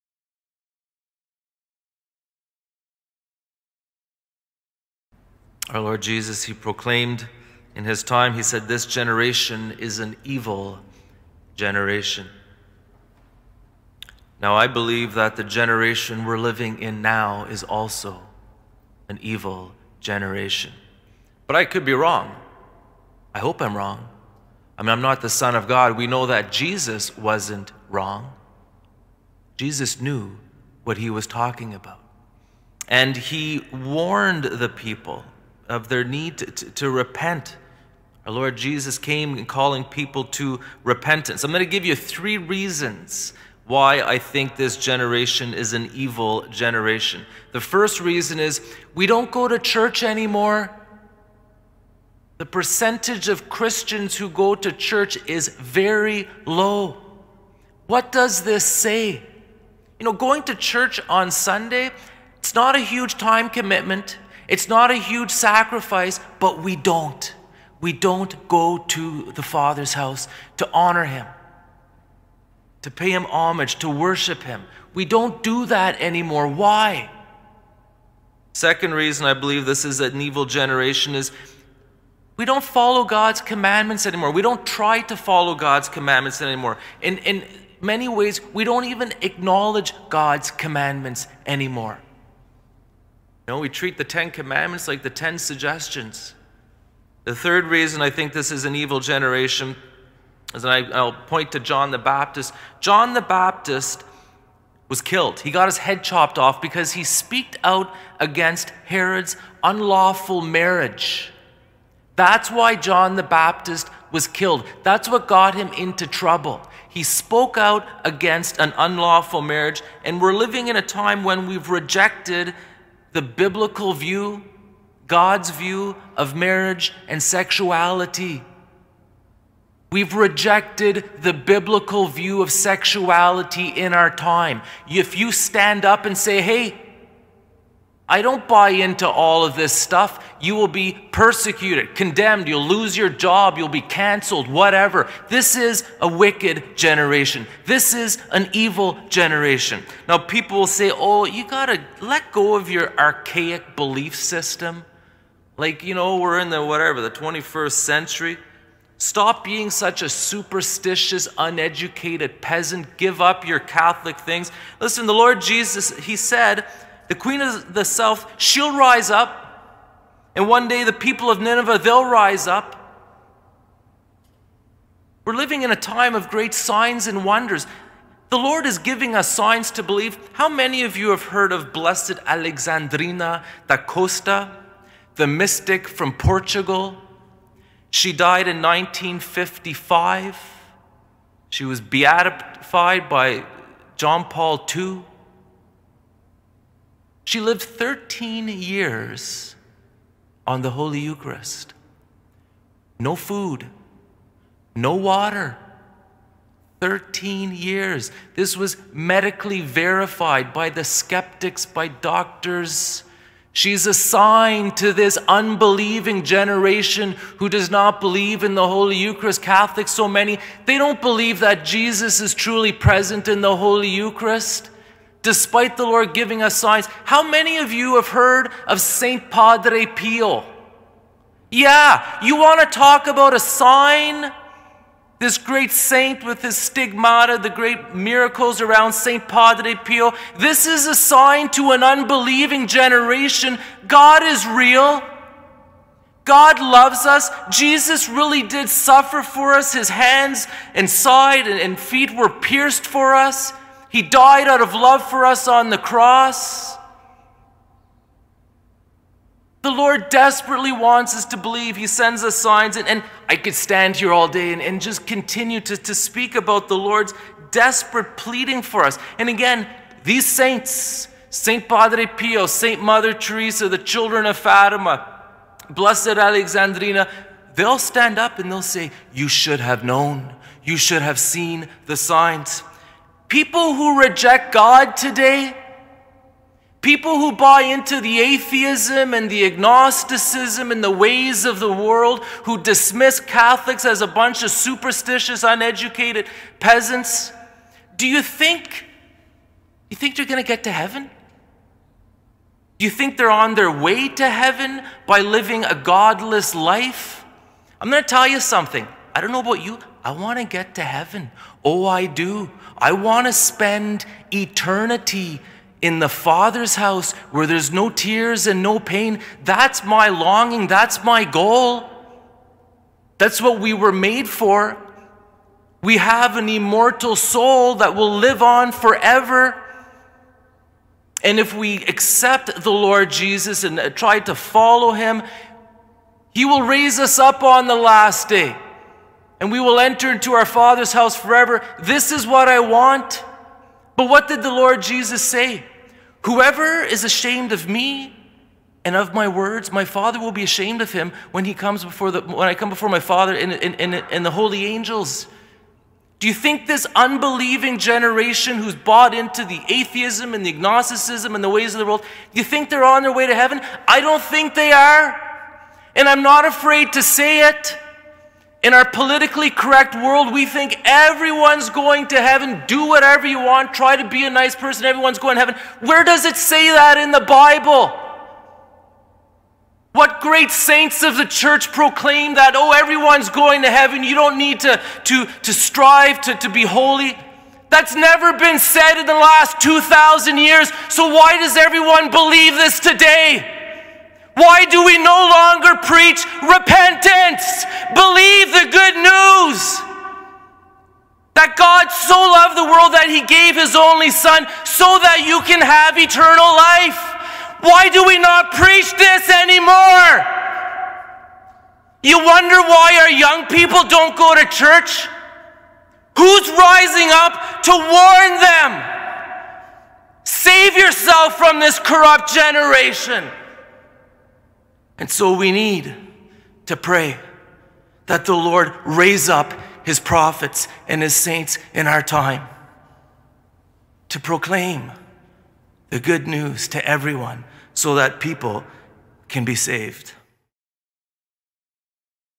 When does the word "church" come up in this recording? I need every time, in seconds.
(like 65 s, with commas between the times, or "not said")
49 s, 54 s, 60 s, 381 s, 414 s.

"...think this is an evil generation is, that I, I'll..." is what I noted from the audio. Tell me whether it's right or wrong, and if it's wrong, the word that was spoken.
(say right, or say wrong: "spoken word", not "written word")
right.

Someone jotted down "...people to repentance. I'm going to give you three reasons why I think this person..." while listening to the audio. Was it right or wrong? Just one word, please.
wrong.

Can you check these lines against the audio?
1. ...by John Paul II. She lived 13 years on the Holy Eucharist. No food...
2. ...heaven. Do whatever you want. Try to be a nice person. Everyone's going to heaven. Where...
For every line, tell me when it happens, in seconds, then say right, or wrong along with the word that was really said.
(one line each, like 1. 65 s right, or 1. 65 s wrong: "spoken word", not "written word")
1. 193 s right
2. 372 s right.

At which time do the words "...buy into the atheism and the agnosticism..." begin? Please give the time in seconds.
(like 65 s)
287 s.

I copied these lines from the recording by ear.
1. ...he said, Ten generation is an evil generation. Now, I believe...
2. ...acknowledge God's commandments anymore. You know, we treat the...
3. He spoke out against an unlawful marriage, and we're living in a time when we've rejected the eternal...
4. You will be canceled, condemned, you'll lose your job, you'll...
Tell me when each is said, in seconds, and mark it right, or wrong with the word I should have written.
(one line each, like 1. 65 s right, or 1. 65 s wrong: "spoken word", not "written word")
1. 8 s wrong: "This", not "Ten"
2. 89 s right
3. 116 s wrong: "biblical", not "eternal"
4. 140 s wrong: "persecuted", not "canceled".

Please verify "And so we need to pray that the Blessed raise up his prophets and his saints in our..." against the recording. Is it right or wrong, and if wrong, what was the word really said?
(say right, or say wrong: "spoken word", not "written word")
wrong: "Lord", not "Blessed".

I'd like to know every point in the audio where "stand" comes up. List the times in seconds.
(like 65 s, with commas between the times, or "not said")
135 s, 263 s, 277 s.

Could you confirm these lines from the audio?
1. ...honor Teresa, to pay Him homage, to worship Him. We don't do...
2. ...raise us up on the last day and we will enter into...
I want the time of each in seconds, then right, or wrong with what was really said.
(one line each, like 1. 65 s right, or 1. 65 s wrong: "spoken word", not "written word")
1. 70 s wrong: "Him", not "Teresa"
2. 336 s right.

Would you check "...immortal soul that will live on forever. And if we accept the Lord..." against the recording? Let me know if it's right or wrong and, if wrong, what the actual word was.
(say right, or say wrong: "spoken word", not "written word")
right.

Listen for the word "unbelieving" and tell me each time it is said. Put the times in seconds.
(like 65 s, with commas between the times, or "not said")
215 s, 241 s, 356 s.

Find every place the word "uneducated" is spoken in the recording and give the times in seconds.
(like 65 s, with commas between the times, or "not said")
161 s, 295 s.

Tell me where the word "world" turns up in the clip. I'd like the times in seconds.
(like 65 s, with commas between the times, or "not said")
291 s, 361 s, 369 s, 402 s.